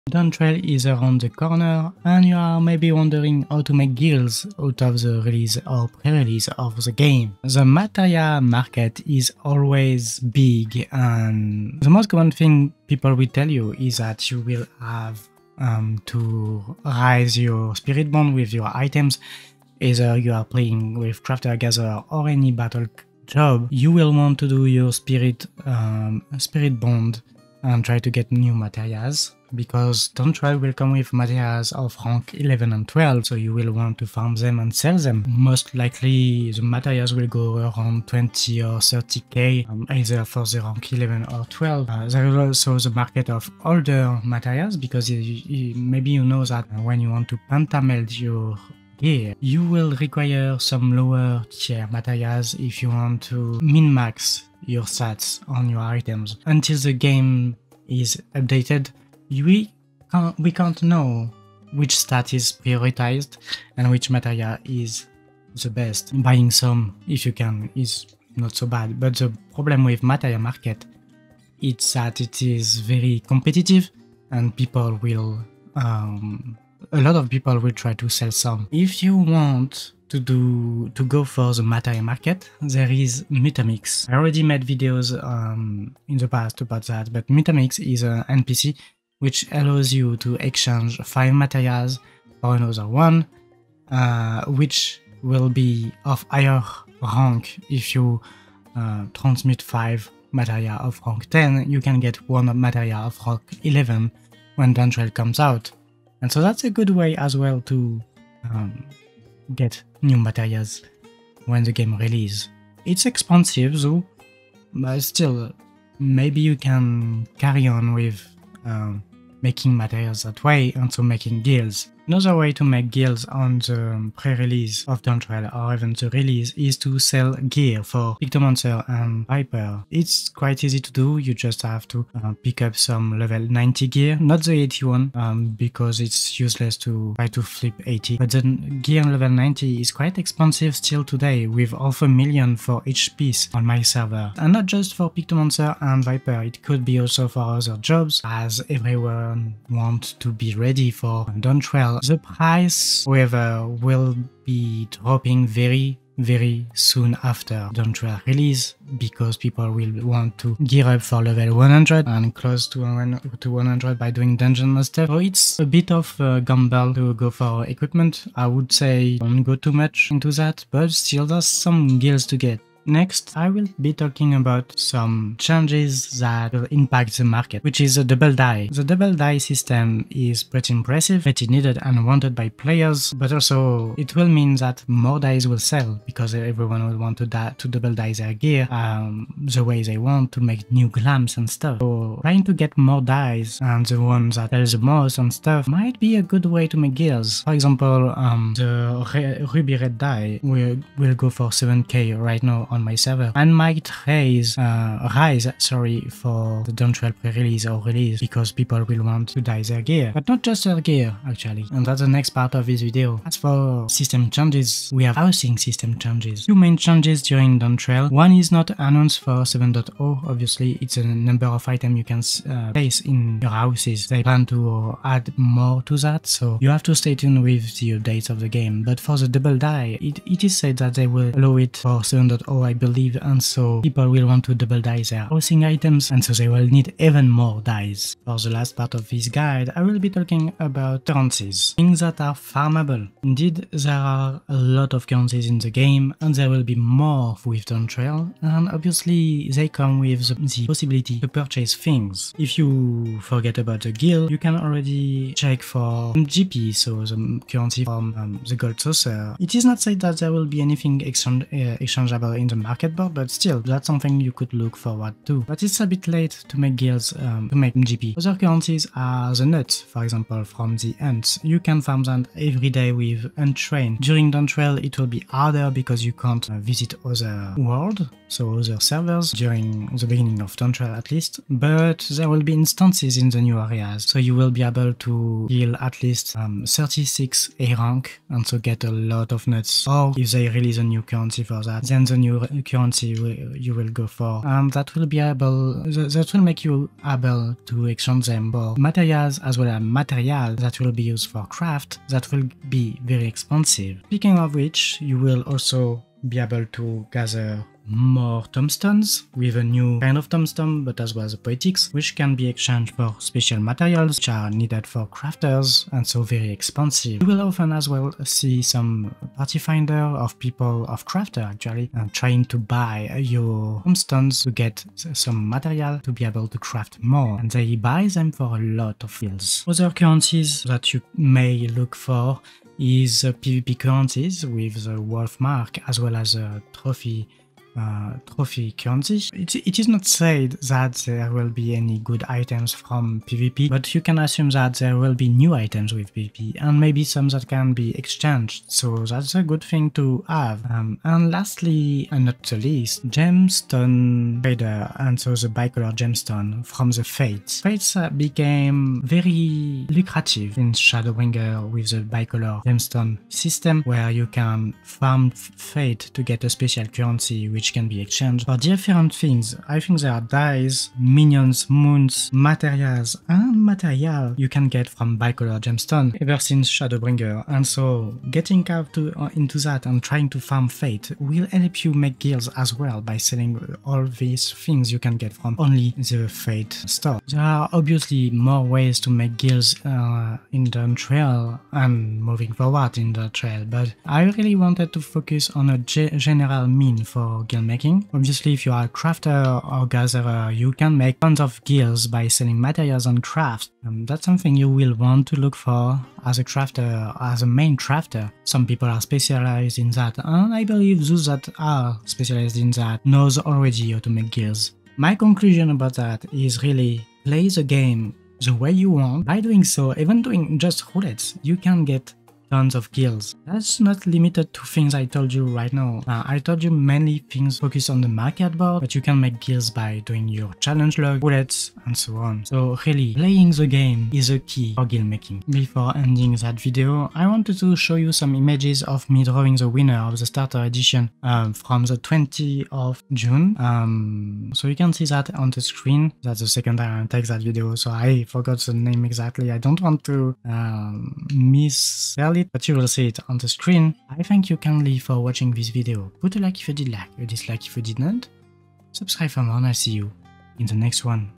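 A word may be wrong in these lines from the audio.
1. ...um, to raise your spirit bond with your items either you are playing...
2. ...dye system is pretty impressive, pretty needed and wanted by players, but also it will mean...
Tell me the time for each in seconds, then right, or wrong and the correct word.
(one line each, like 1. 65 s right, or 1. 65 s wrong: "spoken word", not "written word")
1. 15 s right
2. 179 s right.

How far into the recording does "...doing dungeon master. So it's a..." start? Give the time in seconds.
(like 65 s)
164 s.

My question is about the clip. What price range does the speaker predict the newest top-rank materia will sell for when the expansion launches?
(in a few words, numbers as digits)
20 or 30k.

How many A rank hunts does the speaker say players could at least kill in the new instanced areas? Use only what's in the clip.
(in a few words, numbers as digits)
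36.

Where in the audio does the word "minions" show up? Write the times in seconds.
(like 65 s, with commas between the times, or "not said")
370 s.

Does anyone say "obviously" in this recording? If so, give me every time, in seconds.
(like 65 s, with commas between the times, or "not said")
220 s, 248 s, 387 s, 398 s.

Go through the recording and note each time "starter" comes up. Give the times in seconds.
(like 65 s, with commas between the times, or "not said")
440 s.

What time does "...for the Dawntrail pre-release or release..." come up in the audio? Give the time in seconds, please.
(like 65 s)
206 s.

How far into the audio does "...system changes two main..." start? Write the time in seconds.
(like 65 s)
215 s.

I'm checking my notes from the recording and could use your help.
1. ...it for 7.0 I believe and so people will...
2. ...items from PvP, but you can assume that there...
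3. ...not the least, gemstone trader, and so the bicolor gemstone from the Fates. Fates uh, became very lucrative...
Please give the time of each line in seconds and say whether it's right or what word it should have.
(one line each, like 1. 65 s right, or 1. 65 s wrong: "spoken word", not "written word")
1. 231 s right
2. 342 s right
3. 352 s right.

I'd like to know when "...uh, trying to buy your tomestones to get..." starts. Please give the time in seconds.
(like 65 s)
322 s.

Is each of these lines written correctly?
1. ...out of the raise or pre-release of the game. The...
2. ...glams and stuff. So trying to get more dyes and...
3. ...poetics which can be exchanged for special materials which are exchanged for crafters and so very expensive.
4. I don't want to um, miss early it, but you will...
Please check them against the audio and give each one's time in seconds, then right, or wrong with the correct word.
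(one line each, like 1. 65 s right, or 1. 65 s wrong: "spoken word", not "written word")
1. 4 s wrong: "release", not "raise"
2. 190 s right
3. 311 s wrong: "needed", not "exchanged"
4. 449 s right.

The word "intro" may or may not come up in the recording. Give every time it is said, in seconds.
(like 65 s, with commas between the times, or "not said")
not said.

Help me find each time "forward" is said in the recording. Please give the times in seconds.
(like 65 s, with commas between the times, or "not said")
264 s, 392 s.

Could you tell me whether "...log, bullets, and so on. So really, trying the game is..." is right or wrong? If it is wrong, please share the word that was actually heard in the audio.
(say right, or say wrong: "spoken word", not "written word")
wrong: "playing", not "trying".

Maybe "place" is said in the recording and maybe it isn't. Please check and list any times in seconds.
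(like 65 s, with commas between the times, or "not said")
222 s.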